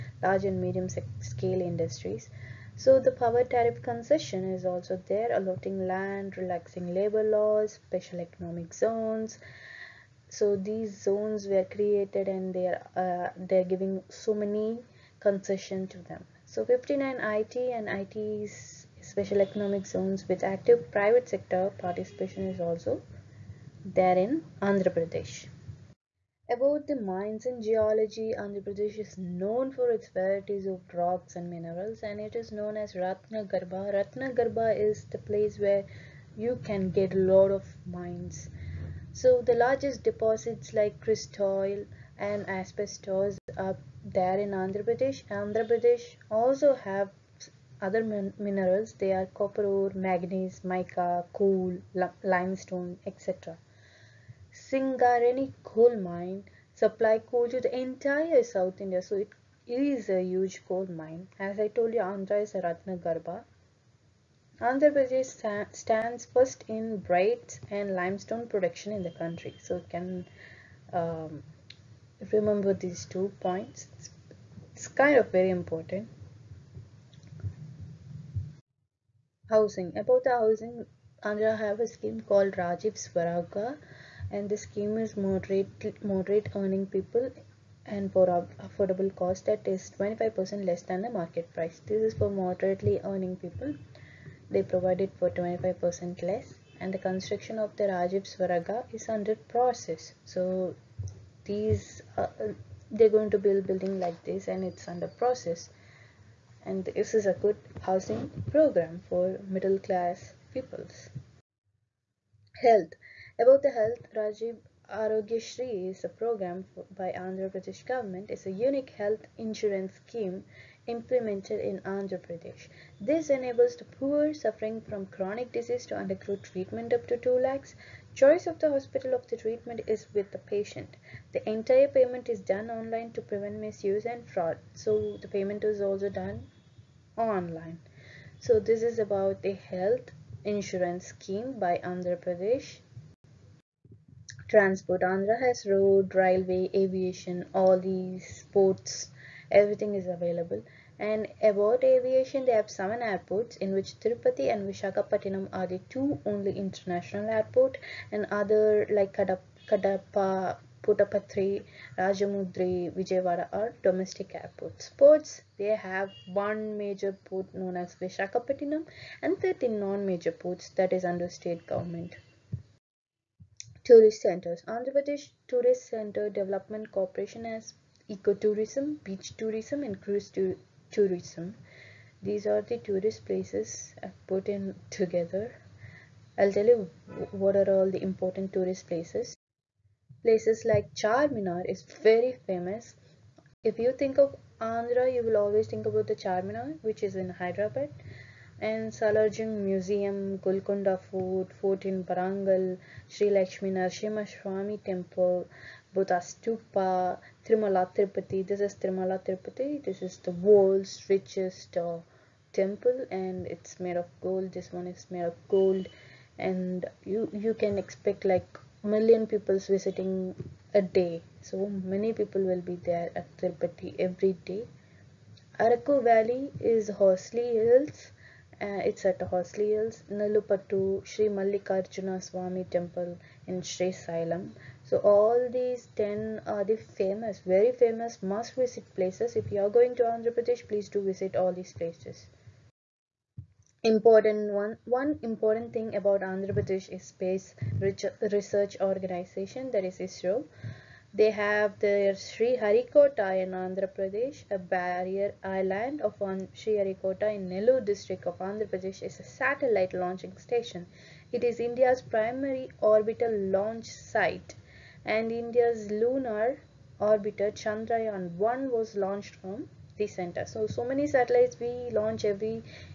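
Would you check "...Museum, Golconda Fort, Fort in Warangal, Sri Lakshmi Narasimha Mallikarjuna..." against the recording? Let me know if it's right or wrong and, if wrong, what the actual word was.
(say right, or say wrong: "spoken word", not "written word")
wrong: "Swami", not "Mallikarjuna".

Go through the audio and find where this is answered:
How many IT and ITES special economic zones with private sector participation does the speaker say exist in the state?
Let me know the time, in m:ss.
0:16.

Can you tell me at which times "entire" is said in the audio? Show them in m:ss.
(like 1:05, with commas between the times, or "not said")
0:57, 2:11.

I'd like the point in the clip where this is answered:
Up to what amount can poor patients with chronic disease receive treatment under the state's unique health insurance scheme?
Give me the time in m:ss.
2:07.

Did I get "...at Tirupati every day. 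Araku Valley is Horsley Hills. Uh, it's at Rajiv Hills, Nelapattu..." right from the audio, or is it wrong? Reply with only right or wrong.
wrong.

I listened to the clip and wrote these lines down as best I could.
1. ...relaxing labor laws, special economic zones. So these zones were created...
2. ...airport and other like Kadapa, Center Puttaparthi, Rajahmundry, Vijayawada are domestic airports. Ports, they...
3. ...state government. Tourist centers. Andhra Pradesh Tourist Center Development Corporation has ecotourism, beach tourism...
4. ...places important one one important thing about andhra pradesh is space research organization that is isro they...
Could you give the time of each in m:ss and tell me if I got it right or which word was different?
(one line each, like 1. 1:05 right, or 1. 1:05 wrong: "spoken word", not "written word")
1. 0:06 right
2. 2:37 wrong: "Kadapa", not "Center"
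3. 2:51 right
4. 4:01 right.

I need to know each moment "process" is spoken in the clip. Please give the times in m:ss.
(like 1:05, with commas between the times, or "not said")
1:39, 1:45.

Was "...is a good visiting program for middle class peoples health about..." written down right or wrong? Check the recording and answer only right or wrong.
wrong.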